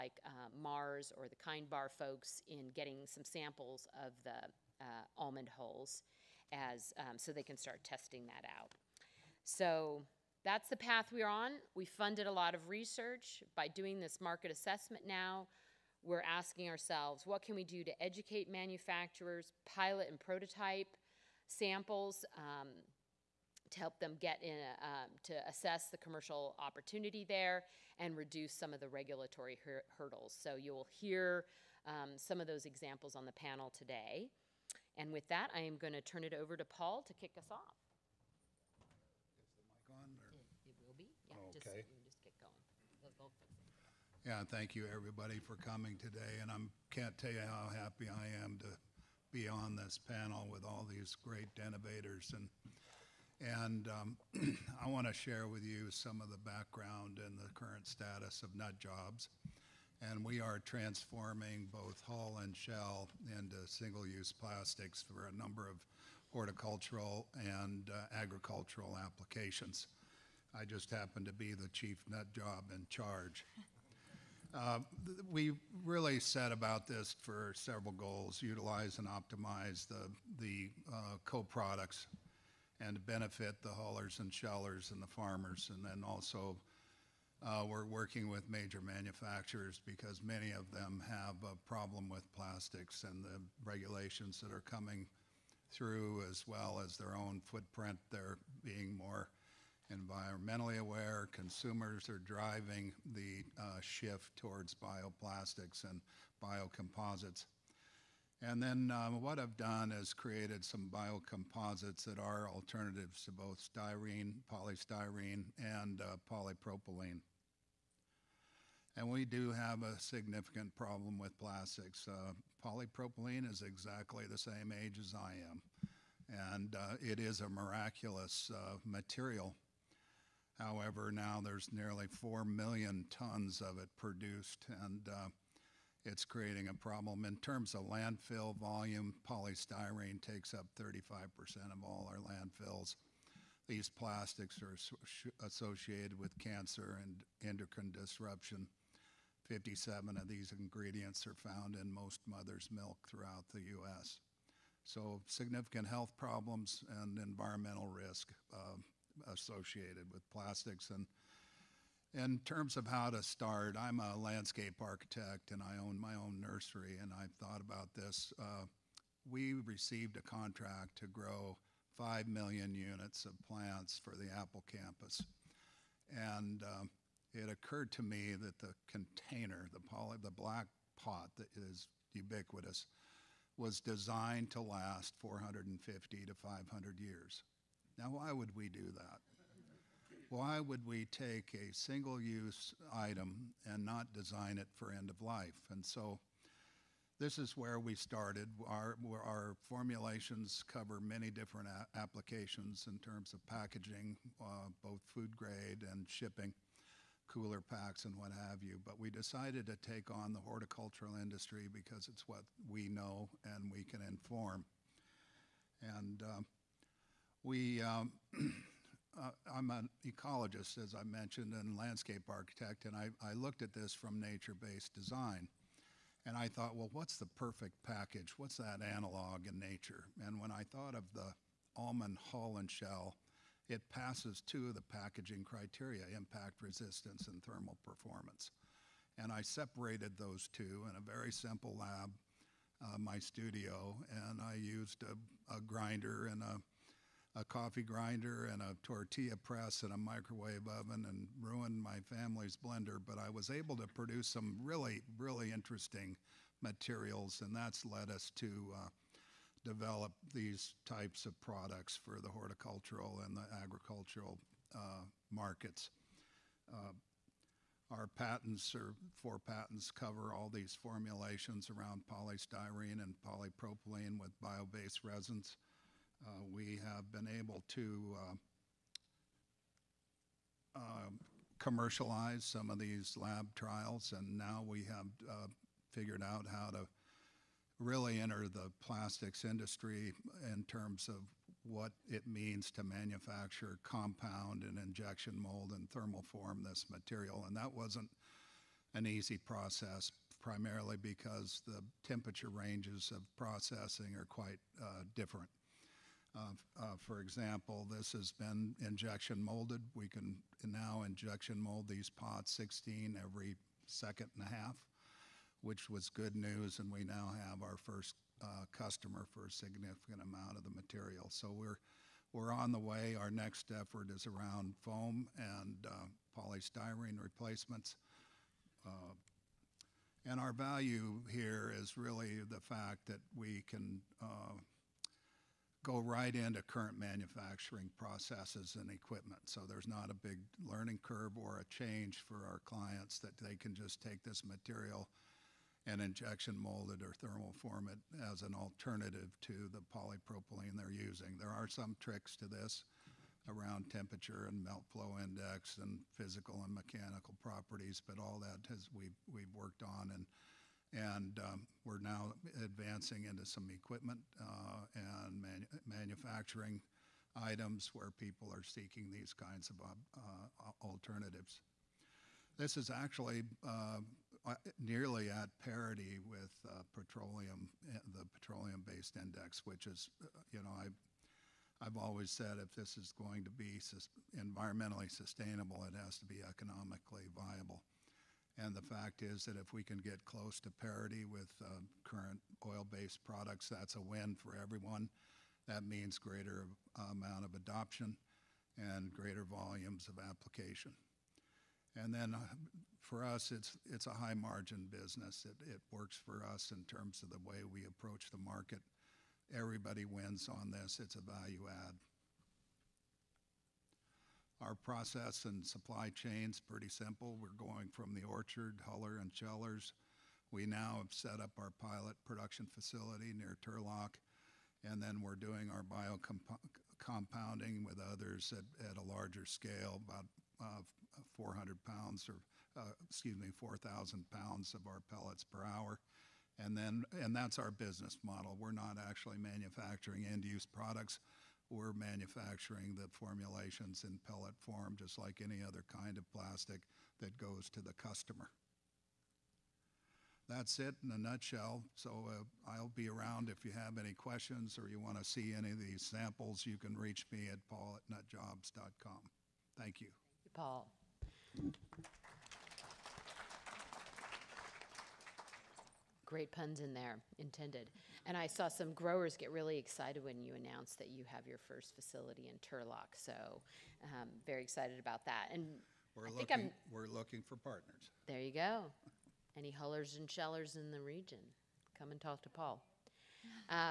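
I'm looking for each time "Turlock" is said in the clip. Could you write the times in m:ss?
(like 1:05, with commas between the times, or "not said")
7:03, 7:52.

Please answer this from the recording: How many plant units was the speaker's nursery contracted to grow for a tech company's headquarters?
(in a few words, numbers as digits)
5 million.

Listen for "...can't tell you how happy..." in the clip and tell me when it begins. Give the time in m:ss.
0:46.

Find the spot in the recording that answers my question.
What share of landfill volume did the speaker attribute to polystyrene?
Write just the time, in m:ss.
2:20.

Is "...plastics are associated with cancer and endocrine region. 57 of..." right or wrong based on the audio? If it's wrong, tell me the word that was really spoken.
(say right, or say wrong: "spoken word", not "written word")
wrong: "disruption", not "region".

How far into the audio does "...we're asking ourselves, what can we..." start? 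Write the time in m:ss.
0:16.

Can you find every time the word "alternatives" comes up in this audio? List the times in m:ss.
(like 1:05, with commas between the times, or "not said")
1:52, 5:48, 6:10.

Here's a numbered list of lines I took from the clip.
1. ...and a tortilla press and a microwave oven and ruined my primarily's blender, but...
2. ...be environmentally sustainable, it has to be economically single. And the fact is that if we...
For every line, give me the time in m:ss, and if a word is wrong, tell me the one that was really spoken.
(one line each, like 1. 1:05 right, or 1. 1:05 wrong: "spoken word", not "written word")
1. 4:08 wrong: "family", not "primarily"
2. 6:23 wrong: "viable", not "single".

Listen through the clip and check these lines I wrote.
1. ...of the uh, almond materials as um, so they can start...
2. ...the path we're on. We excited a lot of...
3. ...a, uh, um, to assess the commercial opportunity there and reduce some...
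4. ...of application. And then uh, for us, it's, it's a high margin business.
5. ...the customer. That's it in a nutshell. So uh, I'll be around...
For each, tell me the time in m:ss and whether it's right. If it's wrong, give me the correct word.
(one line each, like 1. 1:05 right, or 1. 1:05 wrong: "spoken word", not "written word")
1. 0:04 wrong: "hulls", not "materials"
2. 0:10 wrong: "funded", not "excited"
3. 0:24 right
4. 6:40 right
5. 7:27 right.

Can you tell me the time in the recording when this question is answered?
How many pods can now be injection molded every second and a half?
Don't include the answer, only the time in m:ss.
5:12.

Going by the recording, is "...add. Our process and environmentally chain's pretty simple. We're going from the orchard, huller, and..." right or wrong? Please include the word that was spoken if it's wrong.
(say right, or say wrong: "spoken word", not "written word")
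wrong: "supply", not "environmentally".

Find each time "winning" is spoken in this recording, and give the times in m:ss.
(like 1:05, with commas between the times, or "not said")
not said.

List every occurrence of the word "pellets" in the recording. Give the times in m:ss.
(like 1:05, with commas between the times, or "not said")
7:15, 7:24.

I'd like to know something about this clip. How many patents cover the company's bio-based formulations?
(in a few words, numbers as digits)
4.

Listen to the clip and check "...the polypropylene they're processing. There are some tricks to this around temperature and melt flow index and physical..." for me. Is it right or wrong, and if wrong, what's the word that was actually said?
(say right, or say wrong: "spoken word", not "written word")
wrong: "using", not "processing".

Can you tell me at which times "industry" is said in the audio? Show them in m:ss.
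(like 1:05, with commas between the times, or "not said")
3:31, 4:49.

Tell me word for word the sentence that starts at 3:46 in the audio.
And I thought, well, what's the perfect package?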